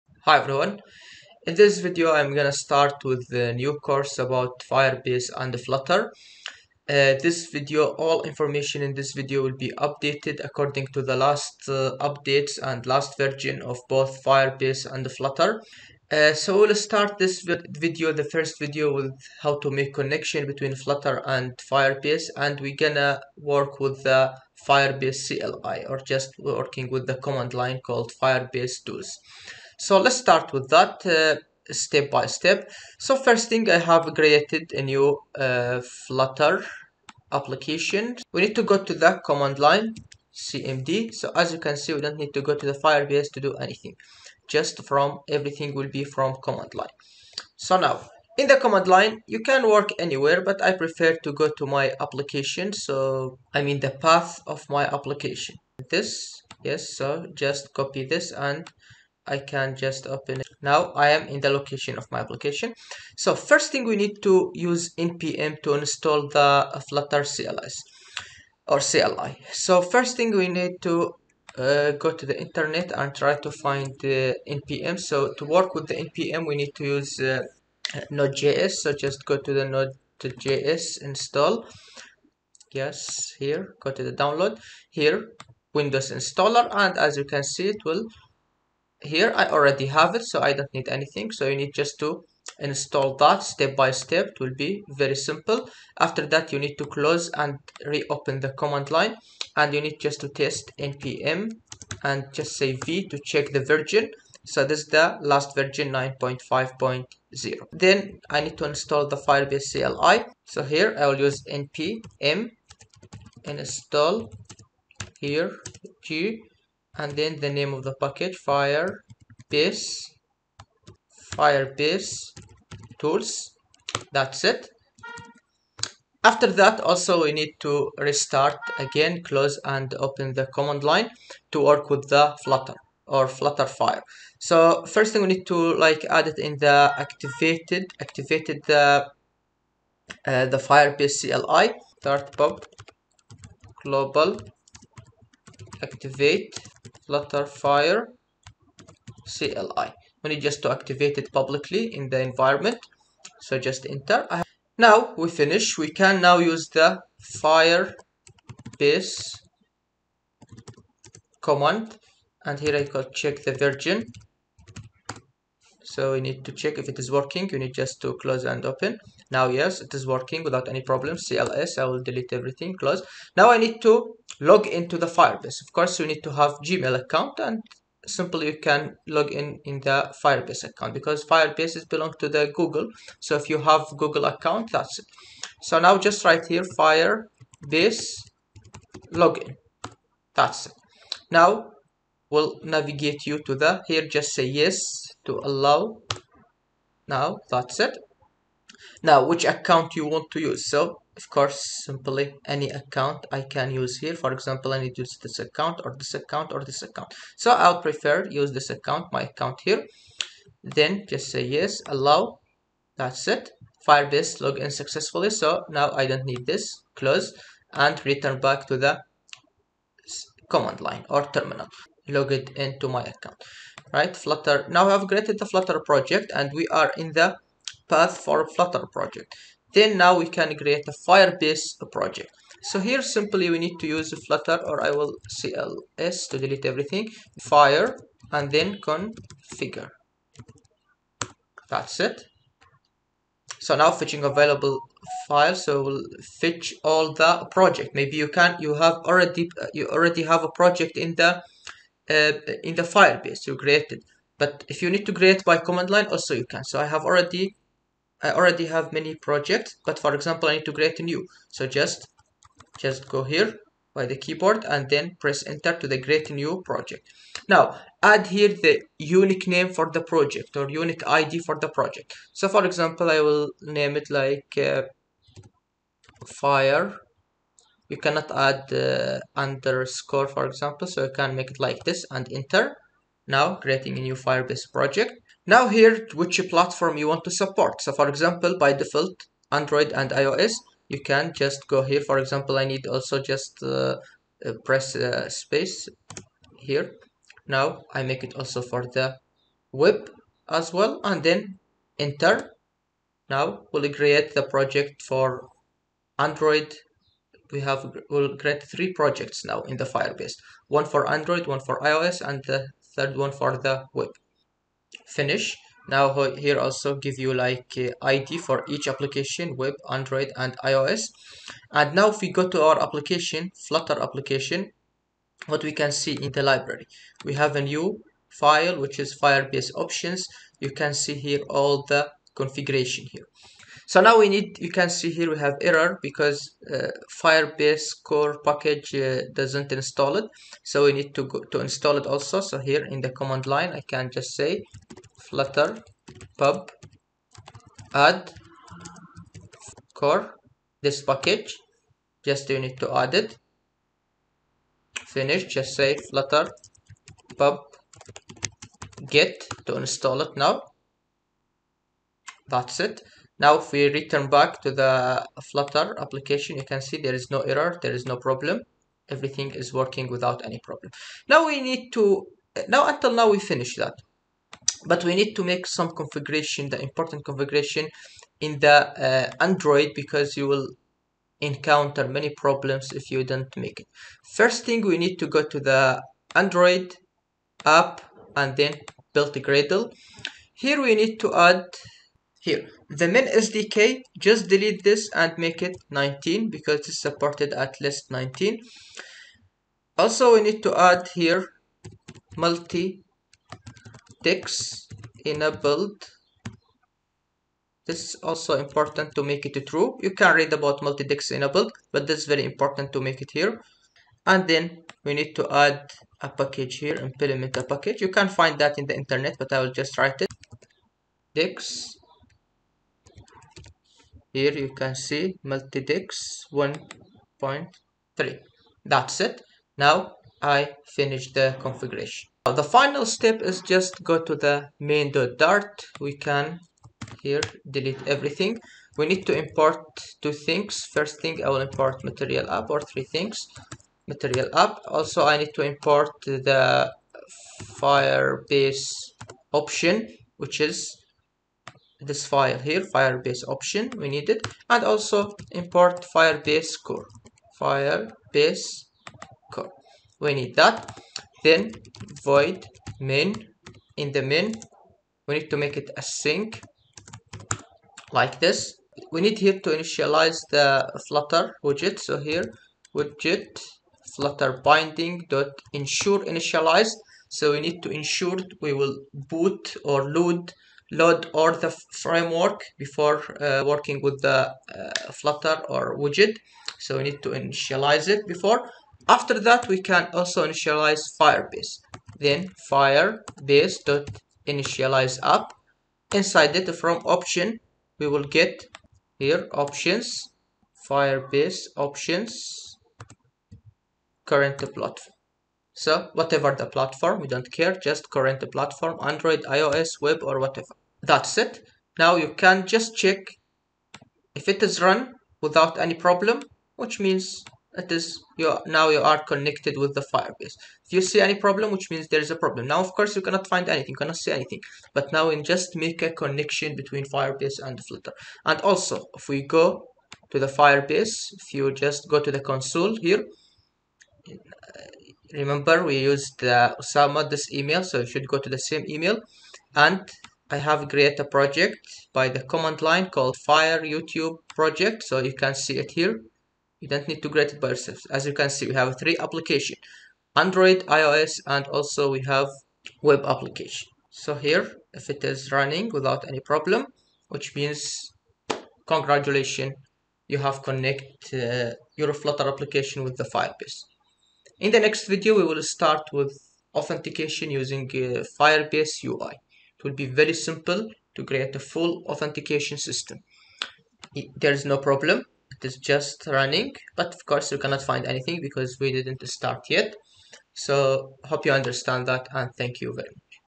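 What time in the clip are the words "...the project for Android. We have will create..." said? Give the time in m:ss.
5:04.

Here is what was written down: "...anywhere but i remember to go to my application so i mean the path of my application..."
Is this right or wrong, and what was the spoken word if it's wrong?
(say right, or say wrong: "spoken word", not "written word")
wrong: "prefer", not "remember".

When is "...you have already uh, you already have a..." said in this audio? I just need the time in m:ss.
4:08.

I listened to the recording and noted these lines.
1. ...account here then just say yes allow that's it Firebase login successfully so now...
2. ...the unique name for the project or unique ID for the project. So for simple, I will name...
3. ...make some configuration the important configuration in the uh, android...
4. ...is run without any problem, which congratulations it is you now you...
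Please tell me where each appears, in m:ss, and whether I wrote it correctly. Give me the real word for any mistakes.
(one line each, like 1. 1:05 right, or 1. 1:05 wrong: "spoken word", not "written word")
1. 3:29 right
2. 4:28 wrong: "example", not "simple"
3. 6:15 right
4. 8:34 wrong: "means", not "congratulations".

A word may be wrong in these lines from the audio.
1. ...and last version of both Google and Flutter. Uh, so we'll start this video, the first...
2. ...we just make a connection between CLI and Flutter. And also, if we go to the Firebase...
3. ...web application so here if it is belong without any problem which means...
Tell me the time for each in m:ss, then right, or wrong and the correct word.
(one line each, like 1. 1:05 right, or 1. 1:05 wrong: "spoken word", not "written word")
1. 0:12 wrong: "Firebase", not "Google"
2. 8:45 wrong: "Firebase", not "CLI"
3. 9:13 wrong: "running", not "belong".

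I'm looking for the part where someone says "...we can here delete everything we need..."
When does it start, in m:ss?
7:15.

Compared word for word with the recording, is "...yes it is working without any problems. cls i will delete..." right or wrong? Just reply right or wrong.
right.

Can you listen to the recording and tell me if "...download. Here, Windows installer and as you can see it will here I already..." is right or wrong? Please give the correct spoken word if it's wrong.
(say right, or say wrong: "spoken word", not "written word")
right.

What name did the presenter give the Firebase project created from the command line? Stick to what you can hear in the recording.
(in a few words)
fire YouTube project.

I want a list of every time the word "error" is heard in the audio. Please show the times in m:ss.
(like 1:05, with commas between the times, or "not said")
5:35, 6:07.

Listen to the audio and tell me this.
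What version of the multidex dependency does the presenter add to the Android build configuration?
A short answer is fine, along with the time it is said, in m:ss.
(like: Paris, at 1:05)
1.3, at 7:06.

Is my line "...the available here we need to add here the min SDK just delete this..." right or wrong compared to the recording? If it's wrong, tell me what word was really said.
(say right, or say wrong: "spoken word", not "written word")
wrong: "gradle", not "available".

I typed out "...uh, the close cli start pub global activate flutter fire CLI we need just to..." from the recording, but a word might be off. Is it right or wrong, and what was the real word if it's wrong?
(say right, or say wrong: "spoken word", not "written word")
wrong: "firebase", not "close".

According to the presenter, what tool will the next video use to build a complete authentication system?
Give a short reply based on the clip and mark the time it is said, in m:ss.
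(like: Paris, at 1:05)
Firebase UI, at 9:28.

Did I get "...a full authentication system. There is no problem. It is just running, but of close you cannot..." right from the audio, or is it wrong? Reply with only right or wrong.
wrong.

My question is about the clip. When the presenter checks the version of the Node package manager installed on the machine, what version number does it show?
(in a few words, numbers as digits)
9.5.0.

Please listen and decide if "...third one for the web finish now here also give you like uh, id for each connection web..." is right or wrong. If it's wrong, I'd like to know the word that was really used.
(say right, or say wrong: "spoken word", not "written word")
wrong: "application", not "connection".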